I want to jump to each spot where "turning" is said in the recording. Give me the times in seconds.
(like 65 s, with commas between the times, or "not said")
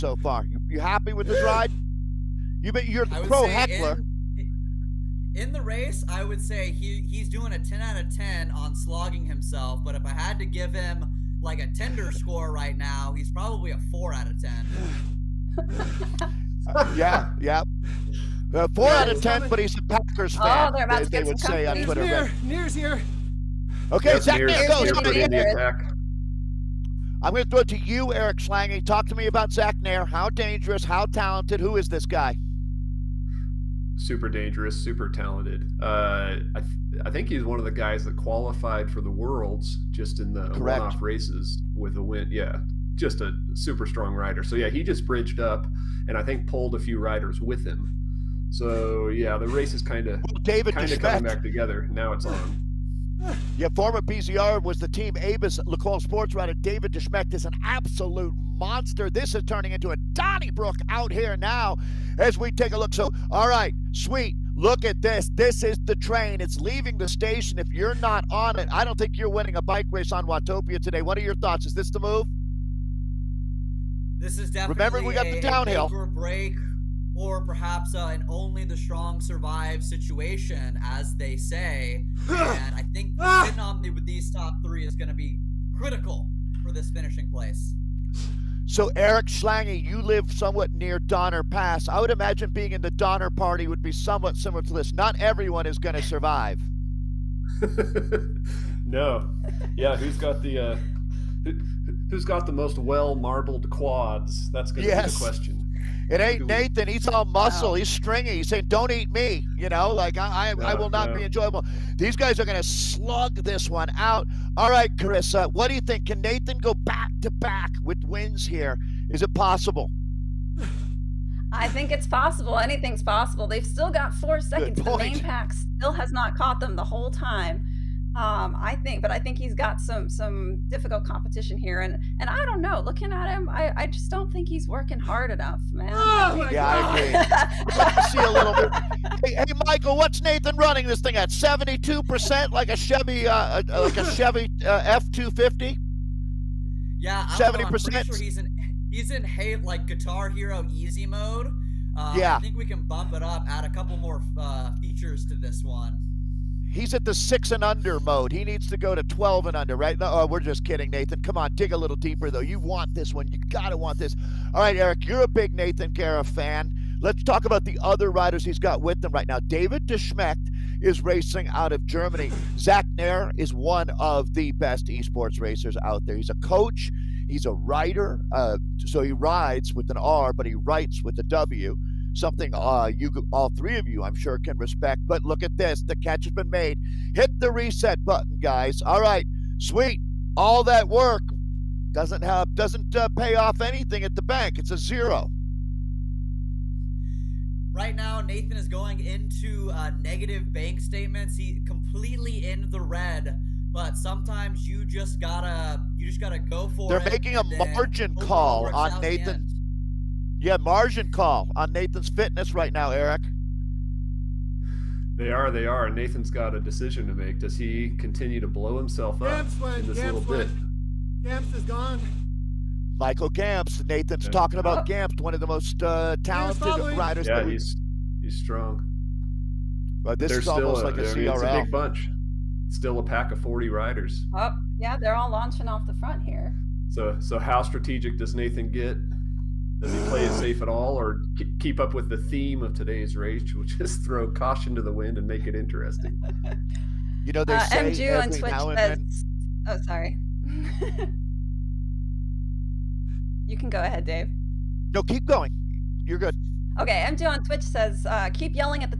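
59 s.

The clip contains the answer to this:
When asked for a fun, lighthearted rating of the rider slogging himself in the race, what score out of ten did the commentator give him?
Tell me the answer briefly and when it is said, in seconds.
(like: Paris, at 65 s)
4, at 13 s.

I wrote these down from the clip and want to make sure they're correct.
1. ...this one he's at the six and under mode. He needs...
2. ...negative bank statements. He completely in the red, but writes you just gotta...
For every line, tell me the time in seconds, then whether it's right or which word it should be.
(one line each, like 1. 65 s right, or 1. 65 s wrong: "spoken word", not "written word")
1. 155 s right
2. 200 s wrong: "sometimes", not "writes".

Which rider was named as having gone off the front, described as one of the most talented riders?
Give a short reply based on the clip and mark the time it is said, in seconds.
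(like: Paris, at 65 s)
Michael Gamps, at 222 s.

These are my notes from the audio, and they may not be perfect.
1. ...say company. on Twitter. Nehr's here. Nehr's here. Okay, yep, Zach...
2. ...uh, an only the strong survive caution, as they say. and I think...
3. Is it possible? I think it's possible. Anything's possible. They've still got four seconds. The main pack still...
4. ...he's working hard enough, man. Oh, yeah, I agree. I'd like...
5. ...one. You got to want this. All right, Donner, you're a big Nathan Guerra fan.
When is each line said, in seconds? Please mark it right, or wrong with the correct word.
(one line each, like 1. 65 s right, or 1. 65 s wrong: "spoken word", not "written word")
1. 21 s right
2. 77 s wrong: "situation", not "caution"
3. 119 s right
4. 134 s right
5. 163 s wrong: "Eric", not "Donner".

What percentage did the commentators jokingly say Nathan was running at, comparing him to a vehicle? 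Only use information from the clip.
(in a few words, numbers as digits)
72%.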